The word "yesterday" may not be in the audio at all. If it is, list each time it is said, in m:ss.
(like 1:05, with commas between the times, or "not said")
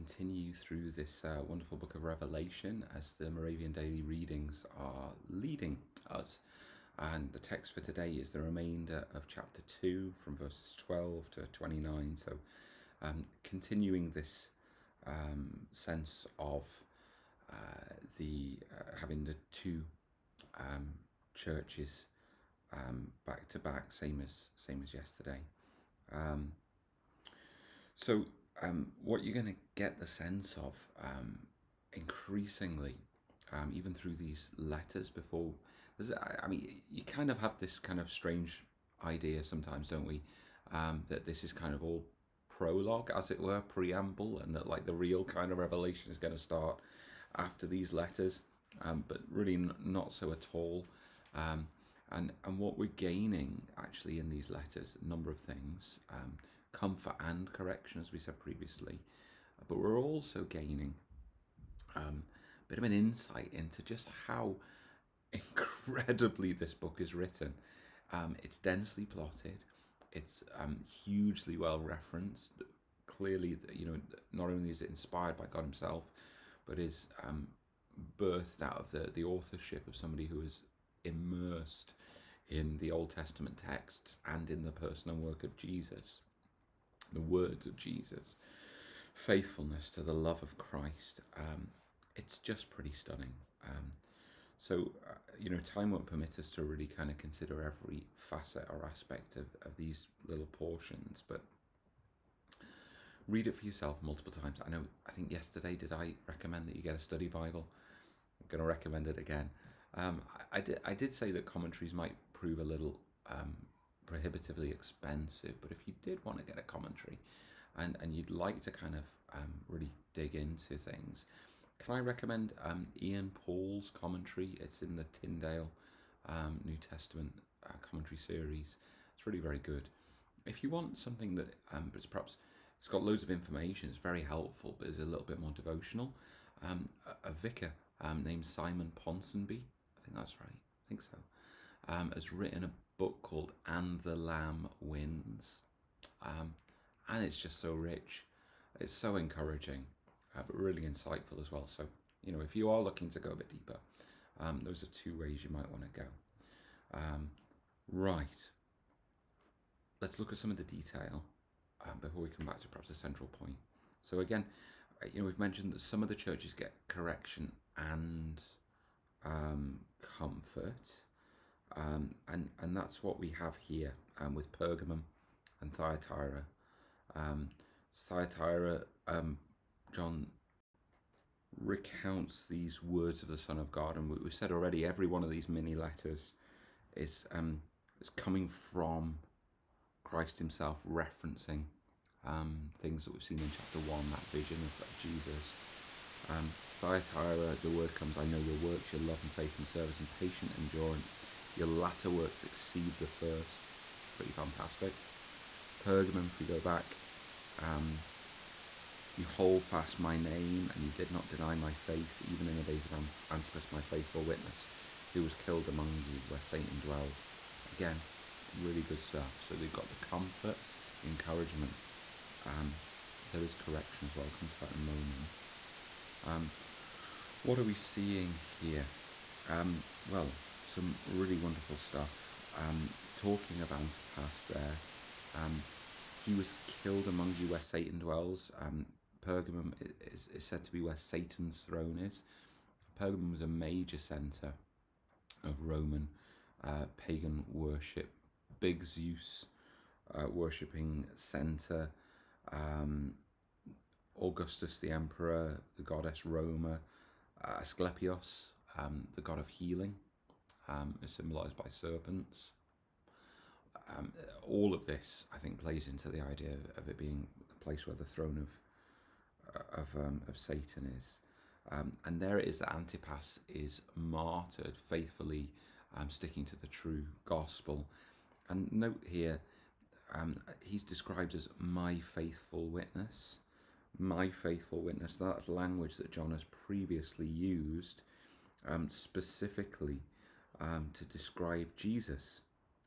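0:24, 1:45.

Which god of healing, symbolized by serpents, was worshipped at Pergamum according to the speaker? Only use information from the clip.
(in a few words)
Asclepios.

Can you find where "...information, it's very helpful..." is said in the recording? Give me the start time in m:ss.
2:13.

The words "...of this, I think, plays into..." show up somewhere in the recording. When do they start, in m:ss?
4:24.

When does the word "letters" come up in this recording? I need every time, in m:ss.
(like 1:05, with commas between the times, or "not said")
0:34, 0:47, 0:54, 3:05.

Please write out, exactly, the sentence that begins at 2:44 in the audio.
So again, uh, you know, we've mentioned that some of the churches get correction and um, comfort.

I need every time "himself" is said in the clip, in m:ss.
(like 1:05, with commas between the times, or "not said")
1:15, 3:10.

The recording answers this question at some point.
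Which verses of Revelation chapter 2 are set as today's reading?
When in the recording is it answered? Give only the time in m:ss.
0:10.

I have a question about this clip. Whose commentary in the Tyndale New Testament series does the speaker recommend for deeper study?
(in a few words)
Ian Paul.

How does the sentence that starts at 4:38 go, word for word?
And note here, he's described as my faithful witness my faithful witness.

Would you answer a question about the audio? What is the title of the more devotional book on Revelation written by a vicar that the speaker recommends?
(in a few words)
And the Lamb Wins.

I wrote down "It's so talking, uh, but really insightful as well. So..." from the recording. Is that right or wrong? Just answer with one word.
wrong.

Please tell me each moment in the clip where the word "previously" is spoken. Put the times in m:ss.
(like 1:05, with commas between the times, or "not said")
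0:58, 4:46.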